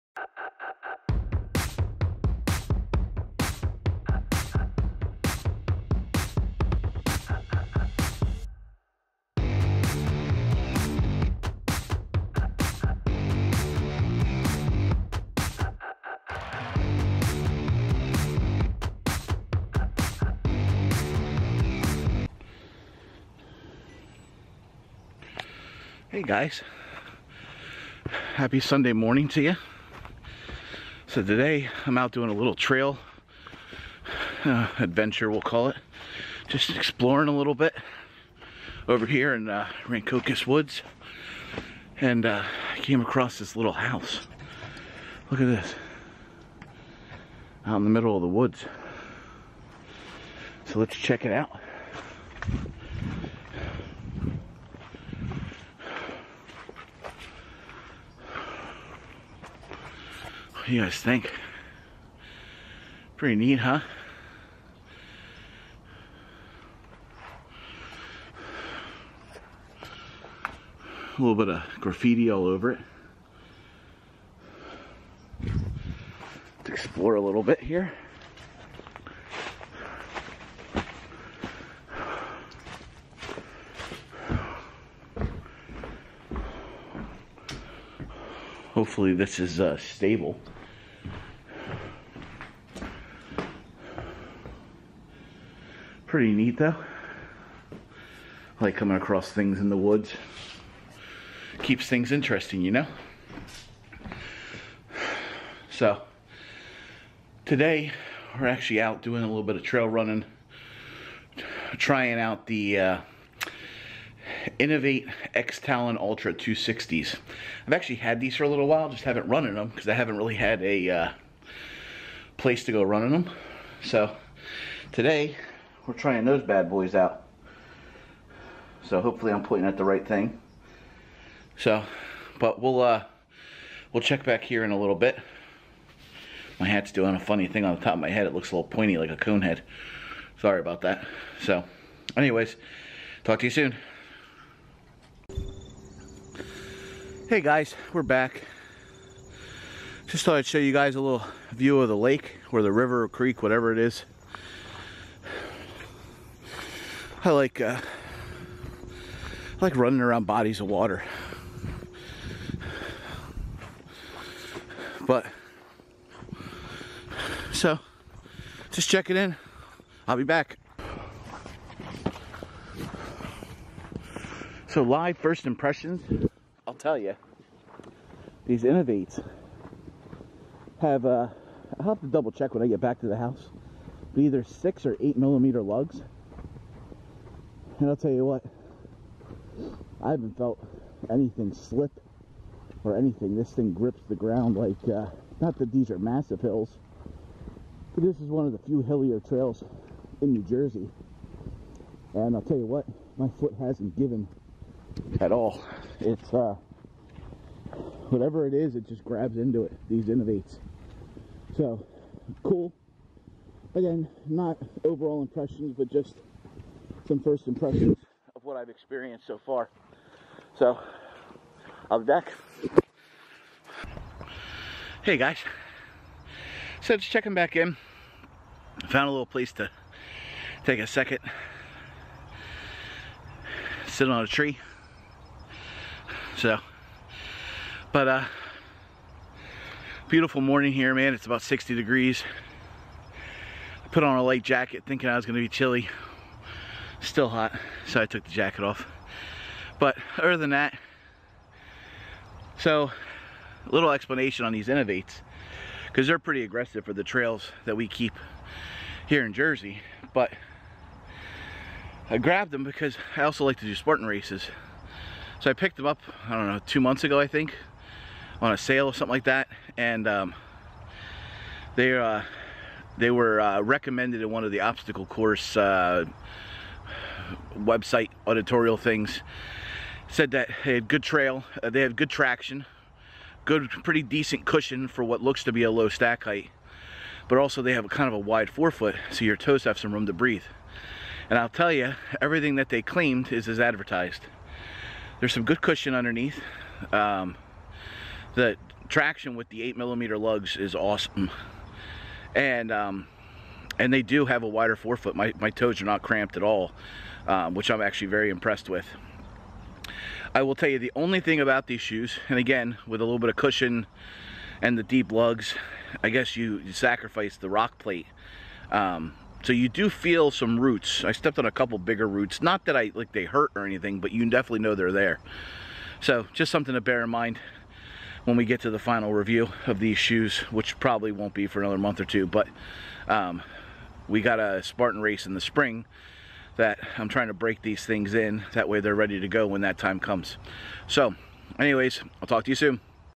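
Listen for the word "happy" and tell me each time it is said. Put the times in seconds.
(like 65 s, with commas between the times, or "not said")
28 s.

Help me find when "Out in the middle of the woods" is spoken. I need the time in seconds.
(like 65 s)
47 s.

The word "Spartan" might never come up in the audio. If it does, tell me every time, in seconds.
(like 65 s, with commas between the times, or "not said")
263 s, 334 s.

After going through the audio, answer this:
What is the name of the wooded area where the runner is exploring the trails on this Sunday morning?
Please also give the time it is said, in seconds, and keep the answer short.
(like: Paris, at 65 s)
Rancocas Woods, at 39 s.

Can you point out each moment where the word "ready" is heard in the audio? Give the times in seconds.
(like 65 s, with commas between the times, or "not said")
338 s.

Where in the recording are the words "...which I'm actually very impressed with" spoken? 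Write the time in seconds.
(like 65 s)
307 s.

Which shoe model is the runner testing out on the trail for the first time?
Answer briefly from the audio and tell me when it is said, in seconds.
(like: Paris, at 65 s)
Inov-8 X Talon Ultra 260, at 115 s.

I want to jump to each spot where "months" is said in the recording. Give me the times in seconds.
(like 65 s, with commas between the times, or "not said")
266 s, 331 s.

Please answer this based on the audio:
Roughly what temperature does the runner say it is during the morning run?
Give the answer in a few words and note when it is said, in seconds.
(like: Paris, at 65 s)
60 degrees, at 241 s.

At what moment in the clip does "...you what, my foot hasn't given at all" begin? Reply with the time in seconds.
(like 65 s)
202 s.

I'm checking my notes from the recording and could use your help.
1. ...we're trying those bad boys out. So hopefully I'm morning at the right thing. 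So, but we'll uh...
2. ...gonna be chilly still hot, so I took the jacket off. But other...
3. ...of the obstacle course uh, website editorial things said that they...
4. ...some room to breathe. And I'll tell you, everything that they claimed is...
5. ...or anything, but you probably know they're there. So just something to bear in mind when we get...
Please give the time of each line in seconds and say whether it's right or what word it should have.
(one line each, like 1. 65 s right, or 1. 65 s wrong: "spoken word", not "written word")
1. 125 s wrong: "pointing", not "morning"
2. 245 s right
3. 274 s right
4. 289 s right
5. 323 s wrong: "definitely", not "probably".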